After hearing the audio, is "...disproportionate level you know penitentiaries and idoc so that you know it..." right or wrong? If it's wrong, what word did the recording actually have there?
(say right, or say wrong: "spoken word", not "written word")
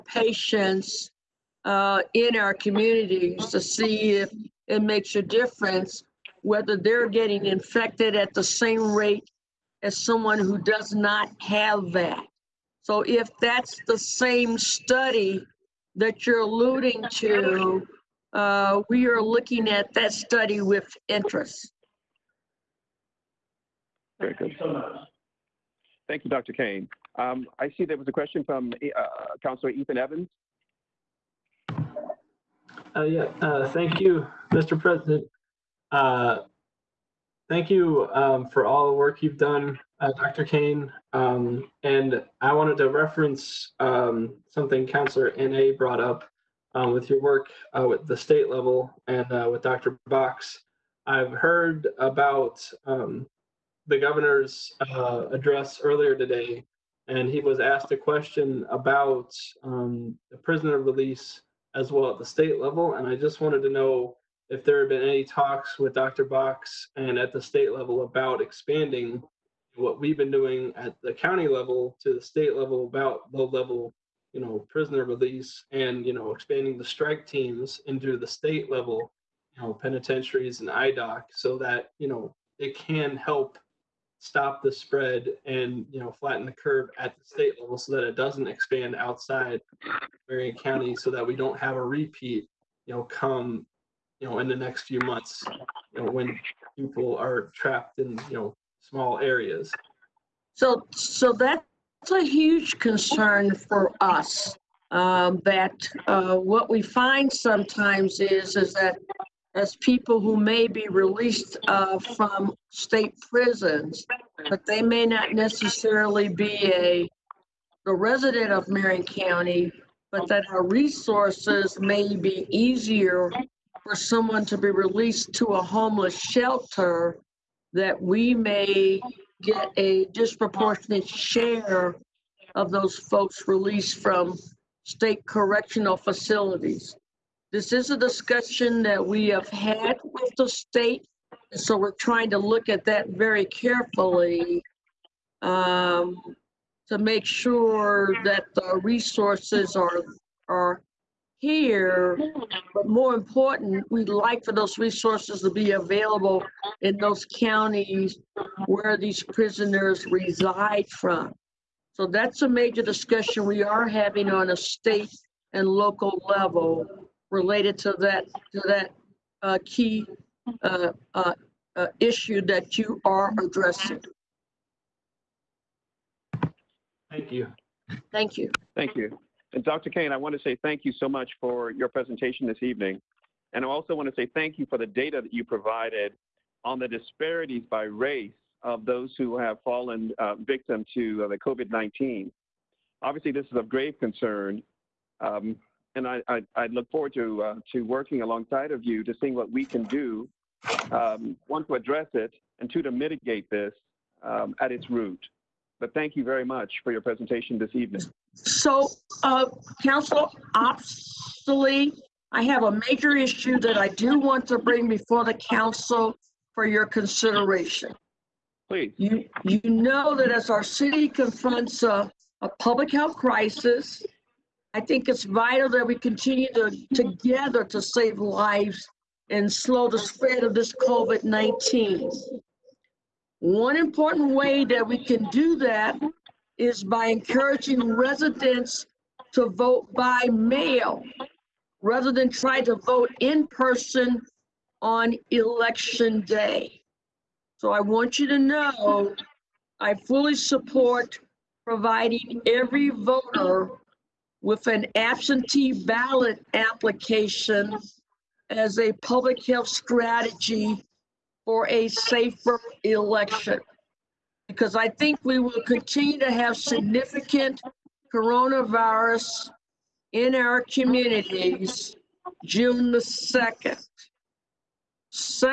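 wrong: "state", not "disproportionate".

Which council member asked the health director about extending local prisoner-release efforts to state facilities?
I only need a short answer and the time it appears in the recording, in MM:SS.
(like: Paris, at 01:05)
Ethan Evans, at 00:29.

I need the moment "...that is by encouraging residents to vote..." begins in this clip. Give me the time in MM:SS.
03:55.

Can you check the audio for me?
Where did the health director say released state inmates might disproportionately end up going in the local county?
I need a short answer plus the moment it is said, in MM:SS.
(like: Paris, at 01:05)
a homeless shelter, at 02:05.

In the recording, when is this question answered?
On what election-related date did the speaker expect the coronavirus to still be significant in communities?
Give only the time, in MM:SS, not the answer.
04:32.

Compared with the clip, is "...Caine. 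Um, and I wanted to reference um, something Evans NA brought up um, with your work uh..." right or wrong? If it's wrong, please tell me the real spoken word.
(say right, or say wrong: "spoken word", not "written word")
wrong: "Counselor", not "Evans".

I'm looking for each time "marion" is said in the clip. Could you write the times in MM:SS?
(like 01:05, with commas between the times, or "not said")
01:30, 01:58.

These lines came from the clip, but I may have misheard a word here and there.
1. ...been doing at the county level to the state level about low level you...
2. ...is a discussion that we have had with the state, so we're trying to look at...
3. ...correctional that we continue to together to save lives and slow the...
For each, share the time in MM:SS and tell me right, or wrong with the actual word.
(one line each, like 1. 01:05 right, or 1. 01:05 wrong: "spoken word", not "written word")
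1. 01:10 right
2. 02:17 right
3. 03:45 wrong: "vital", not "correctional".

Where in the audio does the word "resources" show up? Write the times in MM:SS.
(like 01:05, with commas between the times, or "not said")
02:00, 02:28, 02:34.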